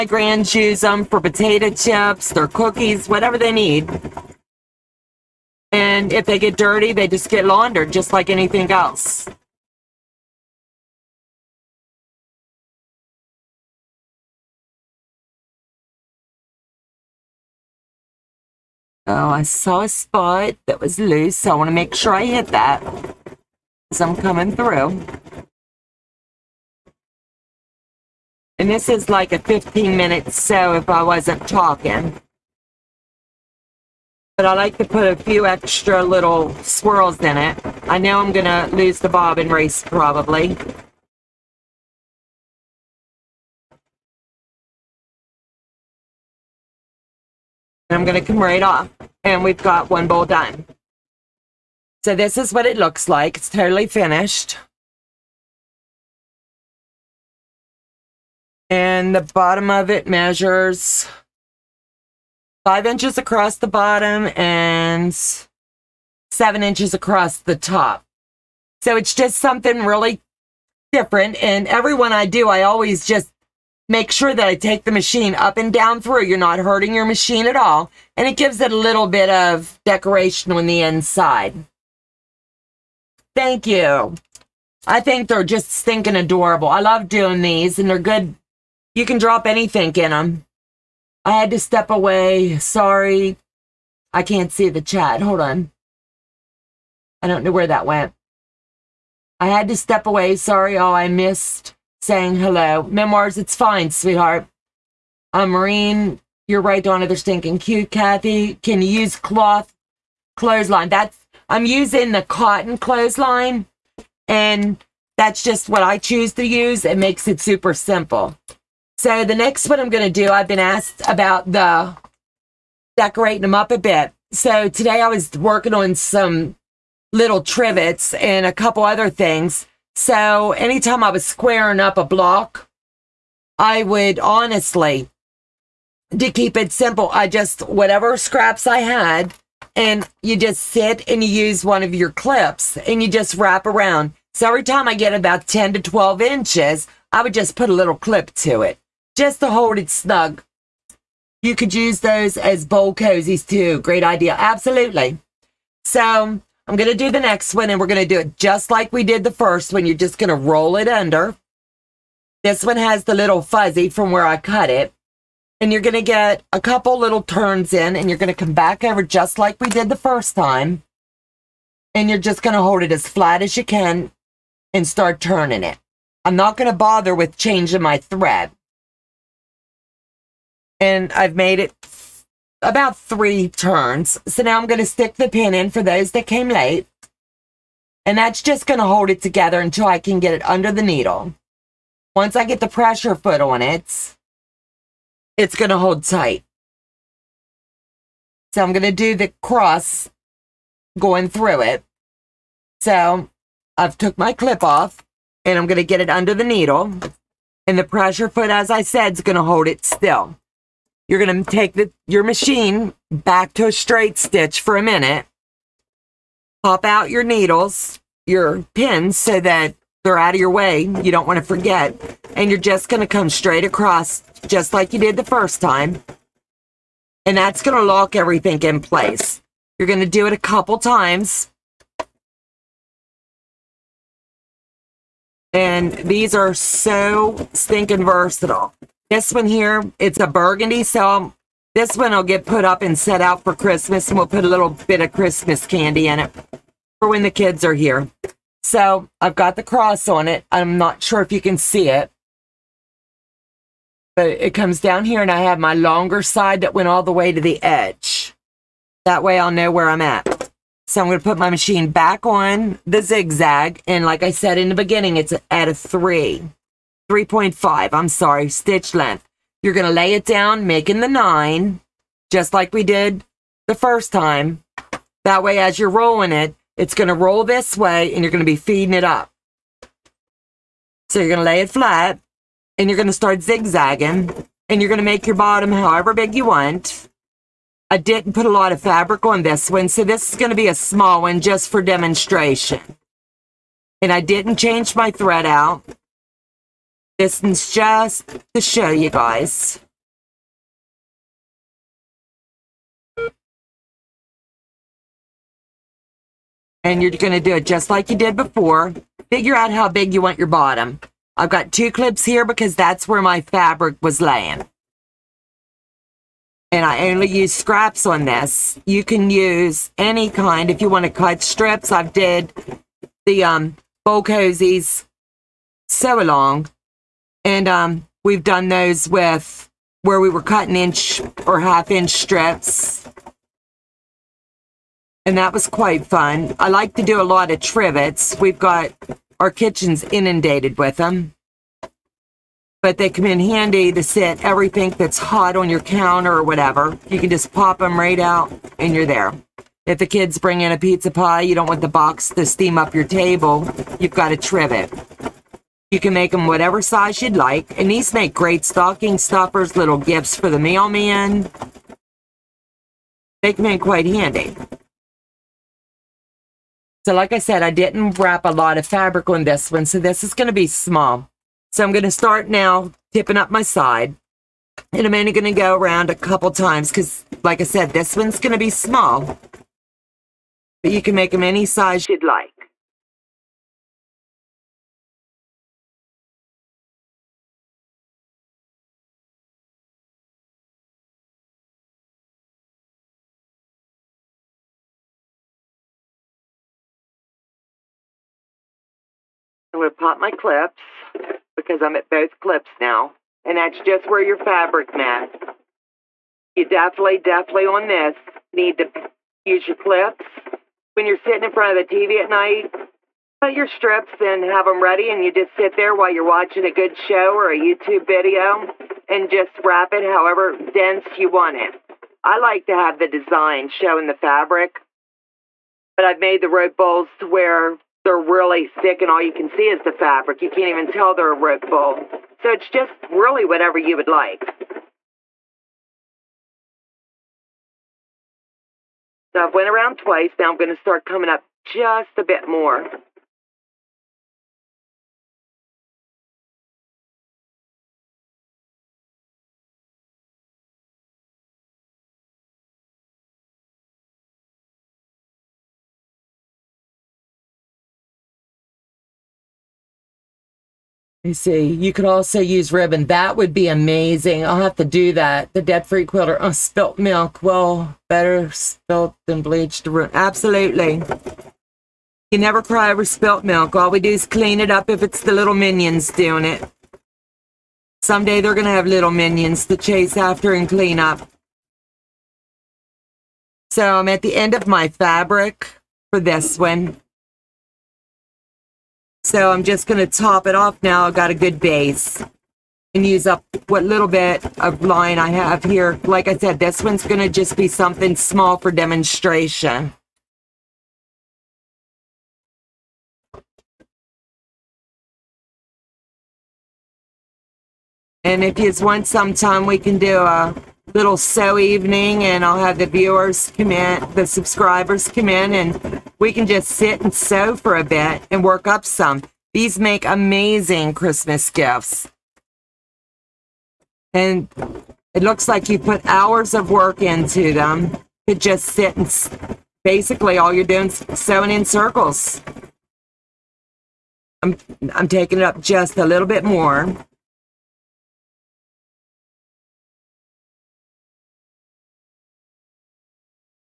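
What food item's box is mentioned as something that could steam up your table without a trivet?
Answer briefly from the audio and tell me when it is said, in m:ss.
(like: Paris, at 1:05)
pizza pie, at 5:50.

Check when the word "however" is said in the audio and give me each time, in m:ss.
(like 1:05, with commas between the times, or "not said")
4:45, 7:00.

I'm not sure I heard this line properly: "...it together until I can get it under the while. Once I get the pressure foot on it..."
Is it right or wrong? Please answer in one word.
wrong.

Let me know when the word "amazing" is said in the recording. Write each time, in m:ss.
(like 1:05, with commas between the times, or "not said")
7:43, 8:40.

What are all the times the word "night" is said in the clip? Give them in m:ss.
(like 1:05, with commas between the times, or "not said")
6:52.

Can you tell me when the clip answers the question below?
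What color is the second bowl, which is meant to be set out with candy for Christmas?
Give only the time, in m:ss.
4:00.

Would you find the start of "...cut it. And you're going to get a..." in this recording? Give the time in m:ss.
2:44.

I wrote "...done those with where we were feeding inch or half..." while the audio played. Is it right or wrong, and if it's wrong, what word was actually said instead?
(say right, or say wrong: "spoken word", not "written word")
wrong: "cutting", not "feeding".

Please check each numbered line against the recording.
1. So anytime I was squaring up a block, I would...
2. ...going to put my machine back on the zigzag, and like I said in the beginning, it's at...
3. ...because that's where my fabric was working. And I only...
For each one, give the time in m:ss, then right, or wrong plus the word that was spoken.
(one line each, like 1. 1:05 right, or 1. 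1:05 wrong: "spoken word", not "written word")
1. 2:09 right
2. 4:21 right
3. 5:12 wrong: "laying", not "working".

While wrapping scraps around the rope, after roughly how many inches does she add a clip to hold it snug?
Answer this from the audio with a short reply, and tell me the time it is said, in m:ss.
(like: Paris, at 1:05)
10 to 12 inches, at 2:25.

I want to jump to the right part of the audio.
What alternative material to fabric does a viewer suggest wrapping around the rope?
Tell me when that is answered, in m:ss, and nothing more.
7:42.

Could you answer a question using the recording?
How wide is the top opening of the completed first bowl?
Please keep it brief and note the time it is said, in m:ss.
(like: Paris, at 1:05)
7 inches, at 1:06.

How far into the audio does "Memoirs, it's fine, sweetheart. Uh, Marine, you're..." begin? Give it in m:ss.
1:42.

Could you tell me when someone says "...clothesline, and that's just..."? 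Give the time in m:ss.
1:52.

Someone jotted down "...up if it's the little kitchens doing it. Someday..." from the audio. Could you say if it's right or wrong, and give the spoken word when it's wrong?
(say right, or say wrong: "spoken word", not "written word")
wrong: "minions", not "kitchens".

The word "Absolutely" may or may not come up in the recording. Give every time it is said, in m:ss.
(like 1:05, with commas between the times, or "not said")
2:34, 7:50.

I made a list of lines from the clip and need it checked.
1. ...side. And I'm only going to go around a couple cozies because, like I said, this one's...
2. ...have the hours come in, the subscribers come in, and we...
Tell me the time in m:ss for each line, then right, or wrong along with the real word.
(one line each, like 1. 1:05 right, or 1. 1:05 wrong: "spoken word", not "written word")
1. 6:13 wrong: "times", not "cozies"
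2. 8:32 wrong: "viewers", not "hours".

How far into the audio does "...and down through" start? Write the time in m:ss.
1:15.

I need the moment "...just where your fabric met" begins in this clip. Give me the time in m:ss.
6:43.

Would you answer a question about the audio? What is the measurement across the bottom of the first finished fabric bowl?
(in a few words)
5 inches.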